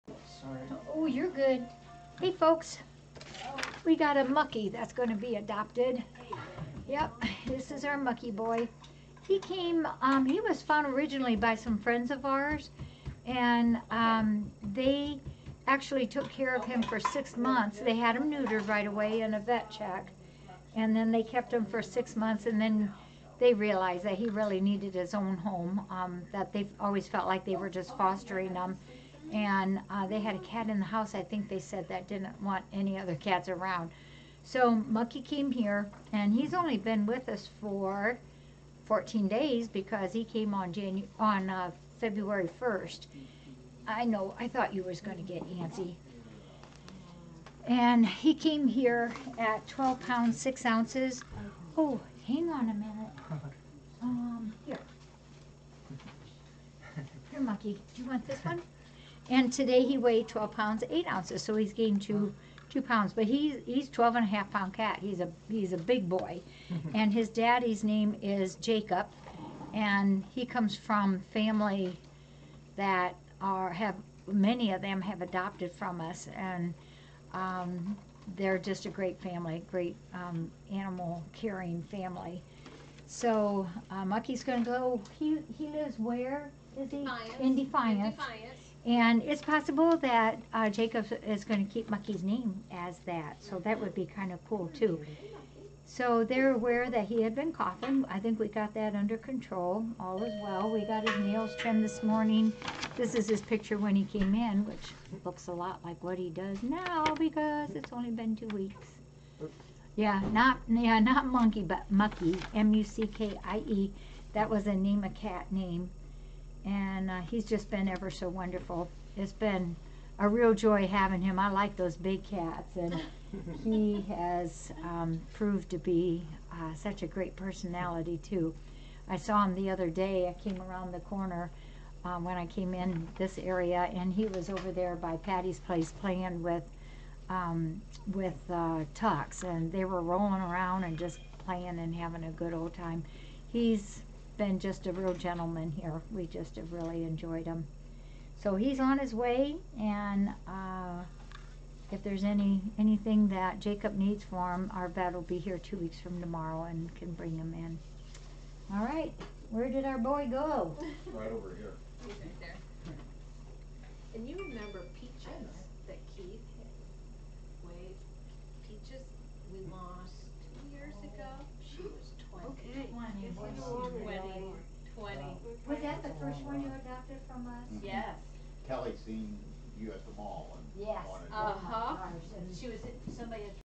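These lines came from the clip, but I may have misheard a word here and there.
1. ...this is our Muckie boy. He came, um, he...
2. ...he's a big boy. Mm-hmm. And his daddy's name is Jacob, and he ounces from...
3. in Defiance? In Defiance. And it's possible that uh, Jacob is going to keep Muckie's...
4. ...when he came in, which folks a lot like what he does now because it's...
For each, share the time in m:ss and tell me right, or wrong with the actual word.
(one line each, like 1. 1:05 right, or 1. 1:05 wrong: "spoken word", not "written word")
1. 0:07 right
2. 1:05 wrong: "comes", not "ounces"
3. 1:27 right
4. 1:43 wrong: "looks", not "folks".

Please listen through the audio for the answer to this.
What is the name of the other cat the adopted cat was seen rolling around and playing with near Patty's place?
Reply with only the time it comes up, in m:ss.
2:18.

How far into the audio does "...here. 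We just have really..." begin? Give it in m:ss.
2:25.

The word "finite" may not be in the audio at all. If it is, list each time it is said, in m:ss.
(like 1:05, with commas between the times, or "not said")
not said.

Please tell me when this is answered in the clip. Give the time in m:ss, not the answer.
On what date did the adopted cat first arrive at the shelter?
0:41.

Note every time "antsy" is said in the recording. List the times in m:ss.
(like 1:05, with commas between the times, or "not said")
0:45.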